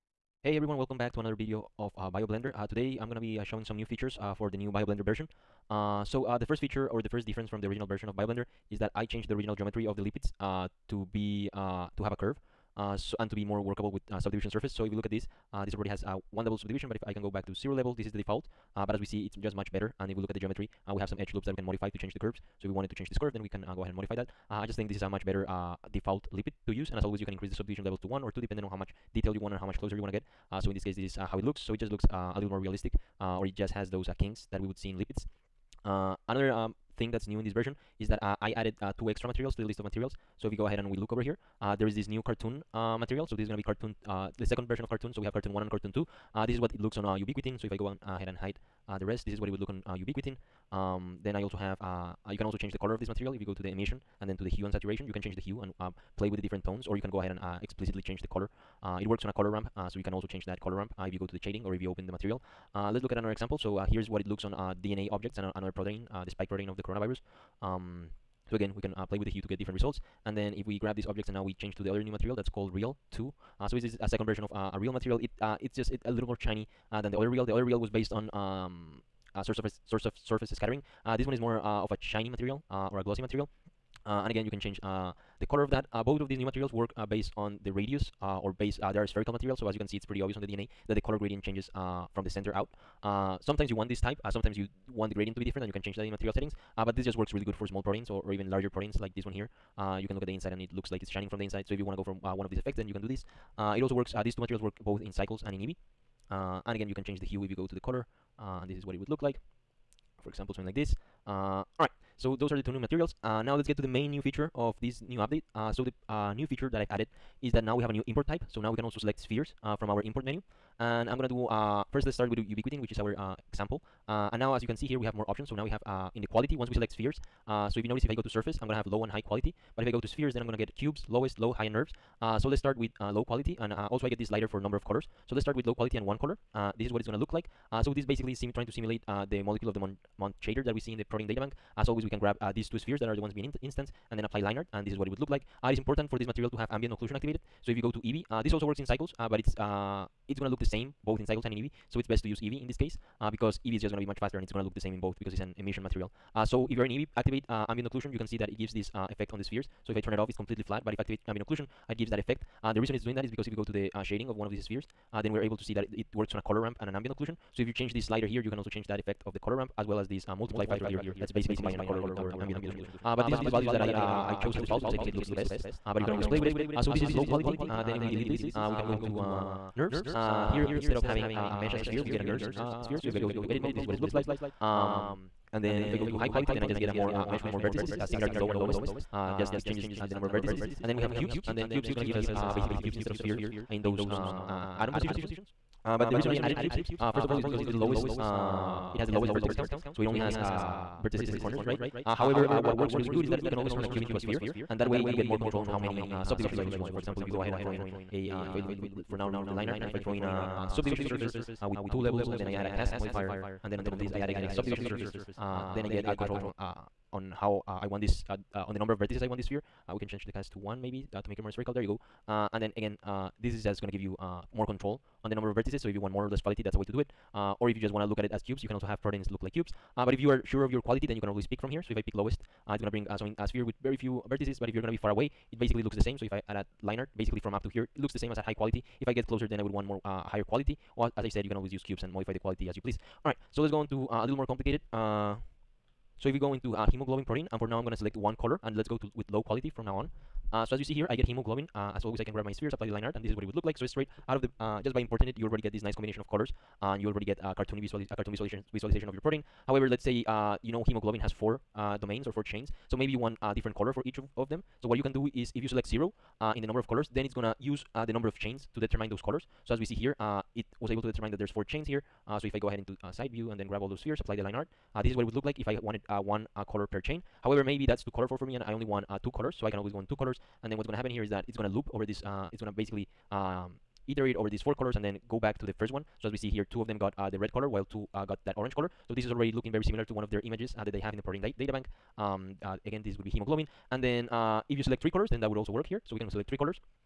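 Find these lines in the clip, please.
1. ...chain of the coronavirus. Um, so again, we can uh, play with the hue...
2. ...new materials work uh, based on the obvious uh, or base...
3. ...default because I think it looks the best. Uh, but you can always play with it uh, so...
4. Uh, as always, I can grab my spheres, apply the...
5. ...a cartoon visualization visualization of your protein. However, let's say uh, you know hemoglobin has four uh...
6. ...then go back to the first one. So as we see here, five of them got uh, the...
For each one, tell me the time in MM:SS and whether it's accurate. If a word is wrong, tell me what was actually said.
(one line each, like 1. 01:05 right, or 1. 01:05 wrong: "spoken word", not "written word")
1. 01:06 wrong: "protein", not "chain"
2. 01:26 wrong: "radius", not "obvious"
3. 02:54 right
4. 04:11 right
5. 04:18 right
6. 04:45 wrong: "two", not "five".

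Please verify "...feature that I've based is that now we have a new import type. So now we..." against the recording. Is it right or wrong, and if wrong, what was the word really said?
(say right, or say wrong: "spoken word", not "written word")
wrong: "added", not "based".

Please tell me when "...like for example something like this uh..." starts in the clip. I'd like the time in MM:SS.
01:49.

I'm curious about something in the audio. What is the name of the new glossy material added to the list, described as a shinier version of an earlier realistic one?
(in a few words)
real 2.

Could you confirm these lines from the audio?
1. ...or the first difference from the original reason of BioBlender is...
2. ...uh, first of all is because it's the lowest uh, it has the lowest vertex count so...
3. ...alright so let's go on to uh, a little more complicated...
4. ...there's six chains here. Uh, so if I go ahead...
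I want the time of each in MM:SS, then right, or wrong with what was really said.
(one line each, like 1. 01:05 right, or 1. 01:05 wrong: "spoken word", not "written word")
1. 00:06 wrong: "version", not "reason"
2. 03:16 right
3. 04:03 right
4. 04:31 wrong: "four", not "six".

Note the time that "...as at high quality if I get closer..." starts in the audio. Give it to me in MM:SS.
03:58.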